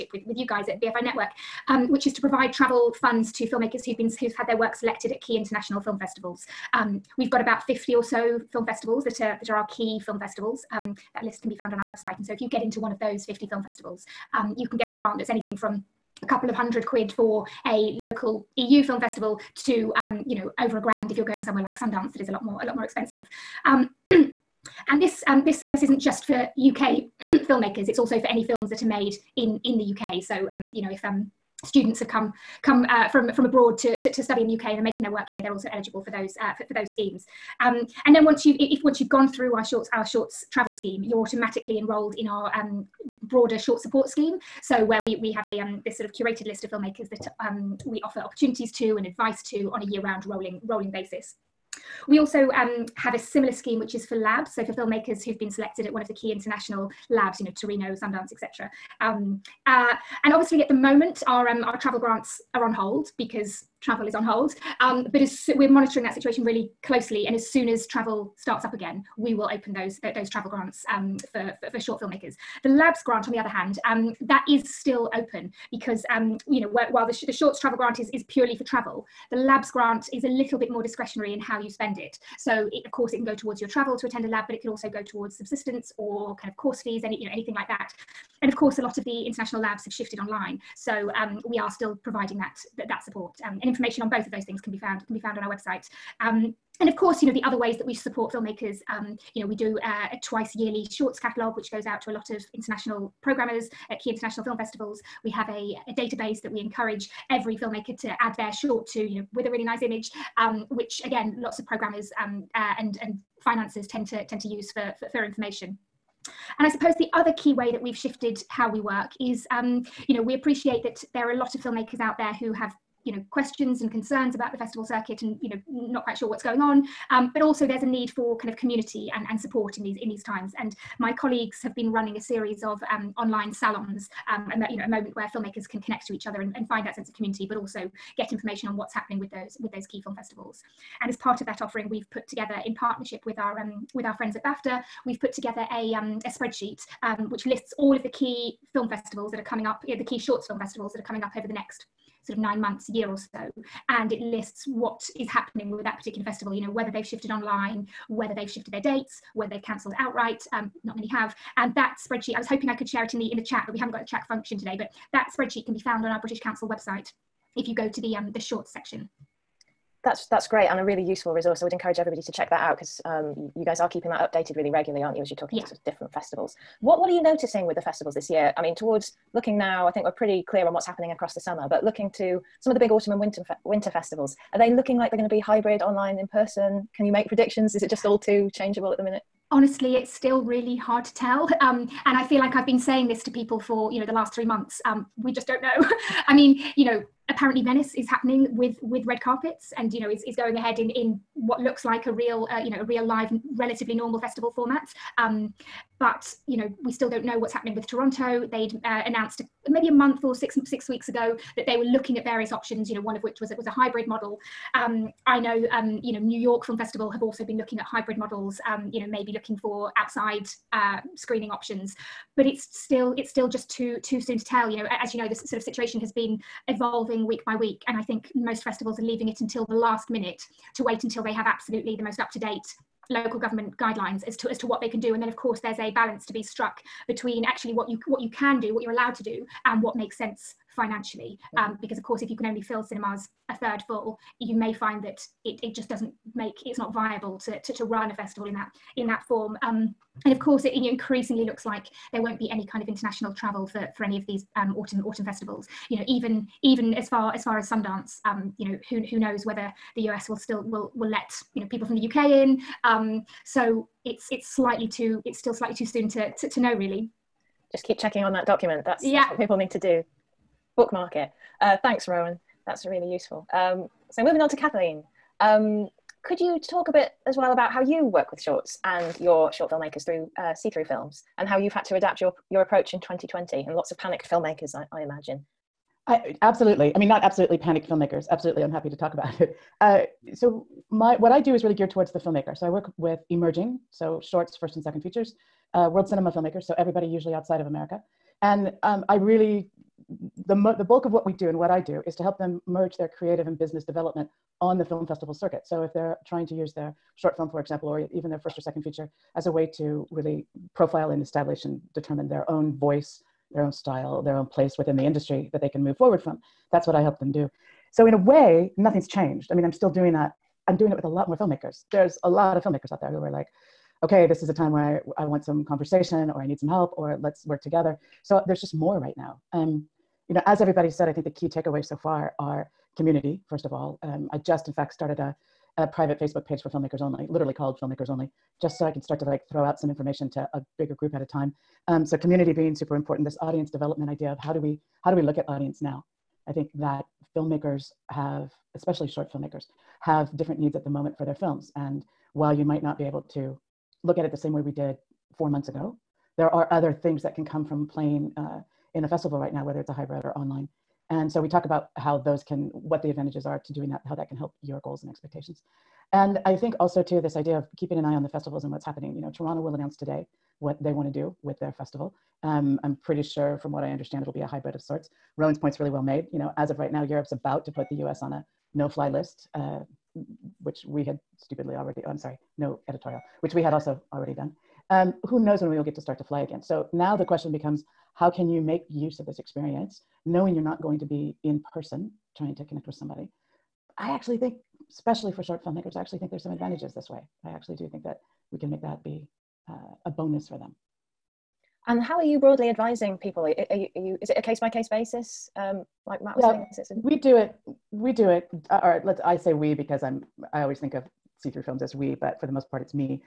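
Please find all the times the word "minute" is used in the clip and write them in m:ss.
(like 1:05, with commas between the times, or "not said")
3:09, 3:50.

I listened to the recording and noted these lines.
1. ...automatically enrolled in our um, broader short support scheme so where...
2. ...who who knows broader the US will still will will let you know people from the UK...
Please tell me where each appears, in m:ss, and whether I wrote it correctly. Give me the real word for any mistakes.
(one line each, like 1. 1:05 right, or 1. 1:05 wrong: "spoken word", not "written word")
1. 0:41 right
2. 4:18 wrong: "whether", not "broader".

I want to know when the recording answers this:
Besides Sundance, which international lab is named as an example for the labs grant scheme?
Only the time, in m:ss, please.
0:57.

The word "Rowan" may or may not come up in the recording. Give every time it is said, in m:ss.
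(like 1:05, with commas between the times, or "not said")
4:32, 6:15.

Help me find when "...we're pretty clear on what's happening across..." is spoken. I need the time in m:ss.
3:00.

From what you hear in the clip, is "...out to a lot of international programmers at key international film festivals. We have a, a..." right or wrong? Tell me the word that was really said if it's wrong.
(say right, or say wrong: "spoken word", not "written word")
right.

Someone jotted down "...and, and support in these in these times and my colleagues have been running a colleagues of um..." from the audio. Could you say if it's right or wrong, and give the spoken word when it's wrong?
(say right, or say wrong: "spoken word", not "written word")
wrong: "series", not "colleagues".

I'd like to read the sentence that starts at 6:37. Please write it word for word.
I actually do think that we can make that be uh, a bonus for them.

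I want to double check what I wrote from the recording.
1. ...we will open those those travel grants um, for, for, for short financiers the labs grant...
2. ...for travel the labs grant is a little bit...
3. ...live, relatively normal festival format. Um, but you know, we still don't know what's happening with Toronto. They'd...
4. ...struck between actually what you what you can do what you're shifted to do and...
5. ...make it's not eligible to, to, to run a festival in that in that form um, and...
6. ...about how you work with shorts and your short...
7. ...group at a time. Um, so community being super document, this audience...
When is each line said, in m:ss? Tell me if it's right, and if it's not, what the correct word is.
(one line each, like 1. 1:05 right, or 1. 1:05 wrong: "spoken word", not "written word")
1. 1:09 wrong: "filmmakers", not "financiers"
2. 1:18 right
3. 3:23 right
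4. 3:56 wrong: "allowed", not "shifted"
5. 4:06 wrong: "viable", not "eligible"
6. 4:37 right
7. 5:40 wrong: "important", not "document".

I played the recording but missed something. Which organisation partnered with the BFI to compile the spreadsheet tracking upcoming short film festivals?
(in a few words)
BAFTA.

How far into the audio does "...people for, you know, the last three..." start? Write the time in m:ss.
3:13.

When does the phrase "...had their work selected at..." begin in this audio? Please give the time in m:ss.
0:04.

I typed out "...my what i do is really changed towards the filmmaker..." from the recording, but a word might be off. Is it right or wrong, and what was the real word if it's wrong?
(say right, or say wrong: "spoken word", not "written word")
wrong: "geared", not "changed".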